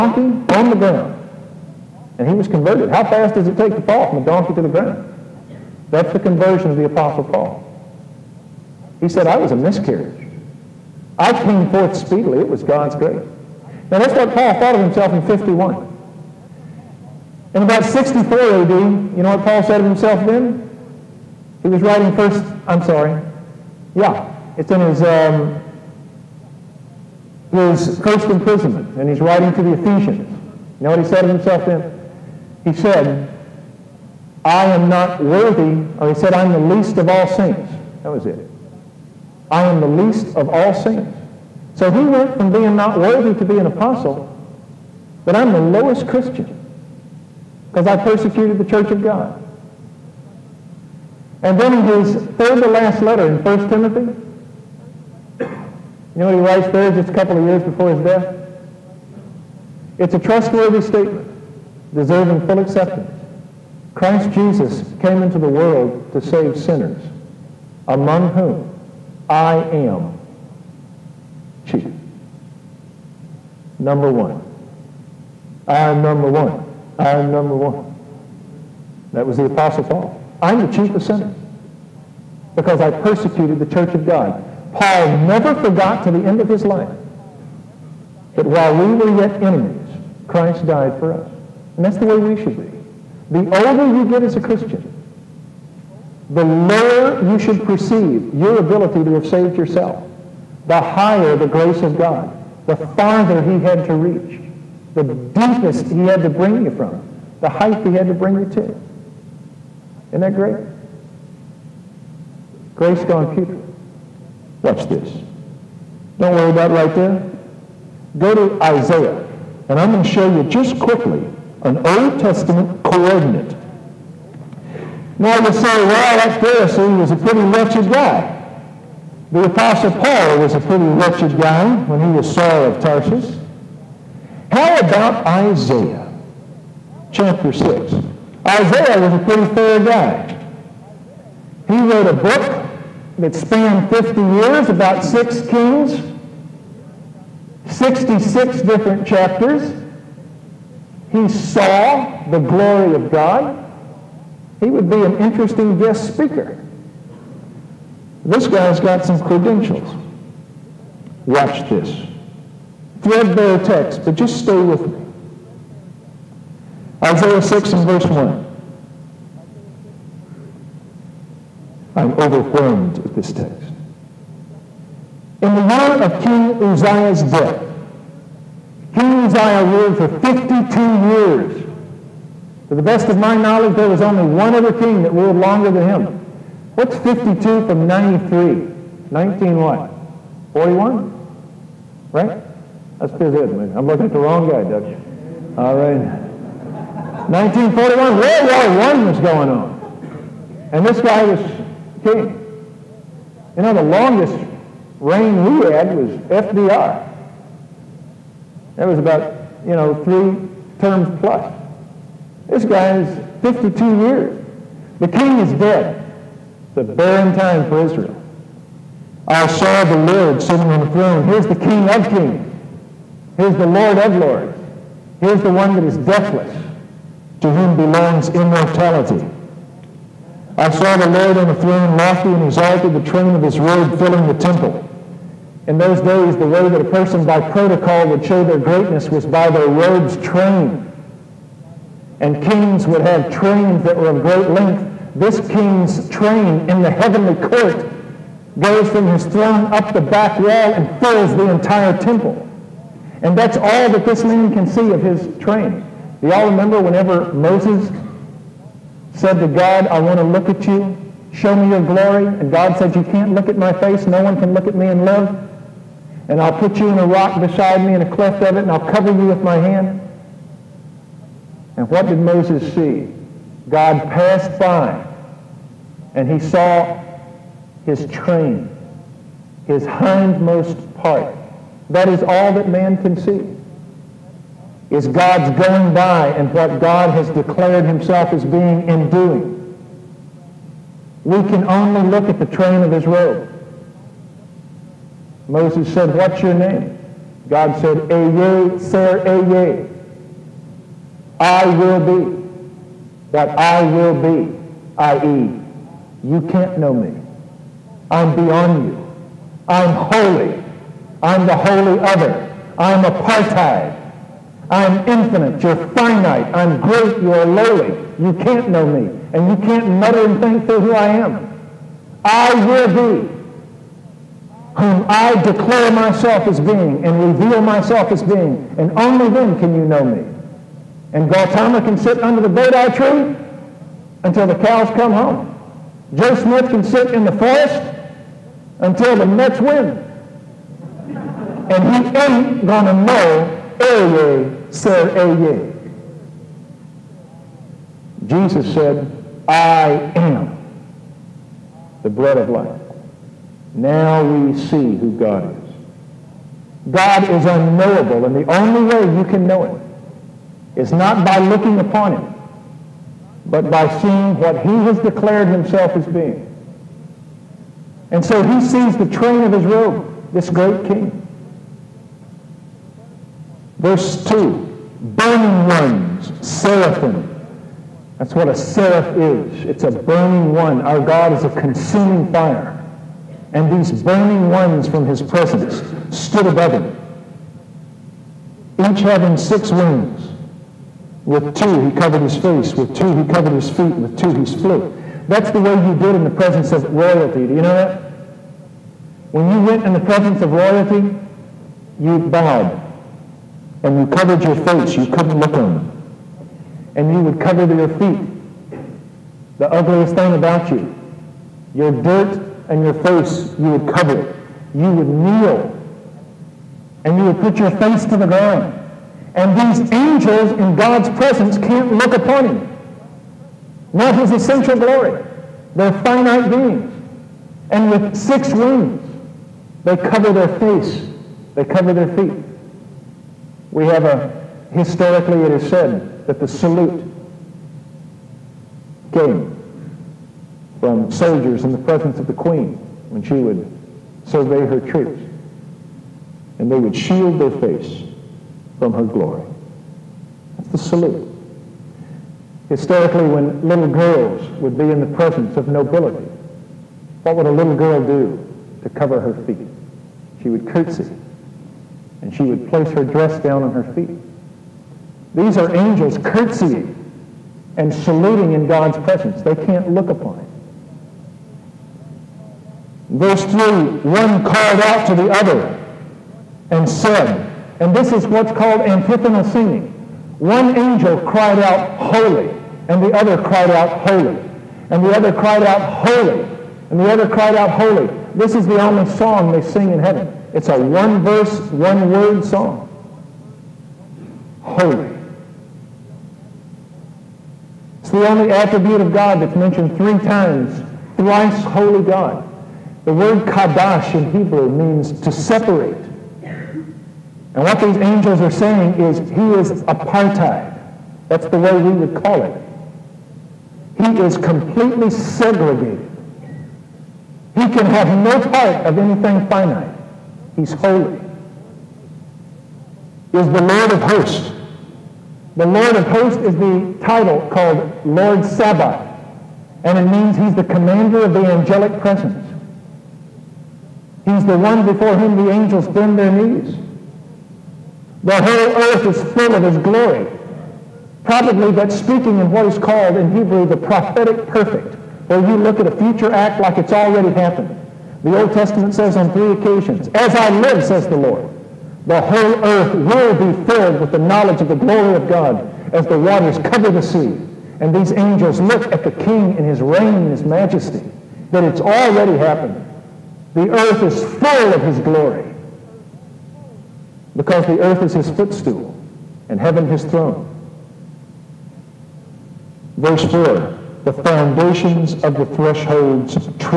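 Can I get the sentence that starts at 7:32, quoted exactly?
Historically, when little girls would be in the presence of nobility, what would a little girl do to cover her feet?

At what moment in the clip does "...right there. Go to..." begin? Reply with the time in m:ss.
1:56.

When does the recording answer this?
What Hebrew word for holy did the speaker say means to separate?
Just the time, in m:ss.
8:23.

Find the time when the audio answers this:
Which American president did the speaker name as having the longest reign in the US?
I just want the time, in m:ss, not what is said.
3:26.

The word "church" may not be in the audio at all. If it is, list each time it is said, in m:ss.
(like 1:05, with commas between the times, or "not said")
0:48, 1:23.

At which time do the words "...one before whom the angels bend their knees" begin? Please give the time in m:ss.
8:54.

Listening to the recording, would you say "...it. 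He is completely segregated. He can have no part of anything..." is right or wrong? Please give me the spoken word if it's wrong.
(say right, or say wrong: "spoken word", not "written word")
right.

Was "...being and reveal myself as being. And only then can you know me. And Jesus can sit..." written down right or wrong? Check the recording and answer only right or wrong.
wrong.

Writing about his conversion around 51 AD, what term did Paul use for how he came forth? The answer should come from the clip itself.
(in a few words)
a miscarriage.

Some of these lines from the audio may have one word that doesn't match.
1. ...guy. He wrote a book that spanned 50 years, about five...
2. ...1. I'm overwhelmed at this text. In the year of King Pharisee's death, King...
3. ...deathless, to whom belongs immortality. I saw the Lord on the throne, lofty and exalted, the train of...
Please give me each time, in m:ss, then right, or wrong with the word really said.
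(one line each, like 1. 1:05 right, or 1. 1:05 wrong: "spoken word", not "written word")
1. 2:19 wrong: "six", not "five"
2. 2:48 wrong: "Uzziah", not "Pharisee"
3. 3:45 right.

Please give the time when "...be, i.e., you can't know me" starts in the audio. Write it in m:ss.
5:04.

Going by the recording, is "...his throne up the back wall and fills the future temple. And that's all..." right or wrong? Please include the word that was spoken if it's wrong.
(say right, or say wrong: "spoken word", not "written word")
wrong: "entire", not "future".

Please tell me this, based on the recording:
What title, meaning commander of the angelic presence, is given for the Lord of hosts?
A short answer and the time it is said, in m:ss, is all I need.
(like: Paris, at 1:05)
Lord Sabaoth, at 8:48.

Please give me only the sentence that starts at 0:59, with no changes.
It's a trustworthy statement, deserving full acceptance.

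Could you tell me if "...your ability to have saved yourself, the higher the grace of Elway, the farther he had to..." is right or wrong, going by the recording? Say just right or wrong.
wrong.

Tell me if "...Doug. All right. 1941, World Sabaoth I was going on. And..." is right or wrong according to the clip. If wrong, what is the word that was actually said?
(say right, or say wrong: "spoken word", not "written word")
wrong: "War", not "Sabaoth".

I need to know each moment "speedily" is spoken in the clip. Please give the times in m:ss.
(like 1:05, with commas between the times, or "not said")
0:11.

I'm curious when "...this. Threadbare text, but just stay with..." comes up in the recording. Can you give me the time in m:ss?
2:41.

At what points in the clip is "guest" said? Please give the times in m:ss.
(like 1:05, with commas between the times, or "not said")
2:35.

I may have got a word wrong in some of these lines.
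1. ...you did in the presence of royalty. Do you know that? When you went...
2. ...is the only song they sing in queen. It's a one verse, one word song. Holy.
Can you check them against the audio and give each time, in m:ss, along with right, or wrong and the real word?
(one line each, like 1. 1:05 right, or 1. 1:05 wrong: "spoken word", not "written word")
1. 6:35 right
2. 8:08 wrong: "heaven", not "queen".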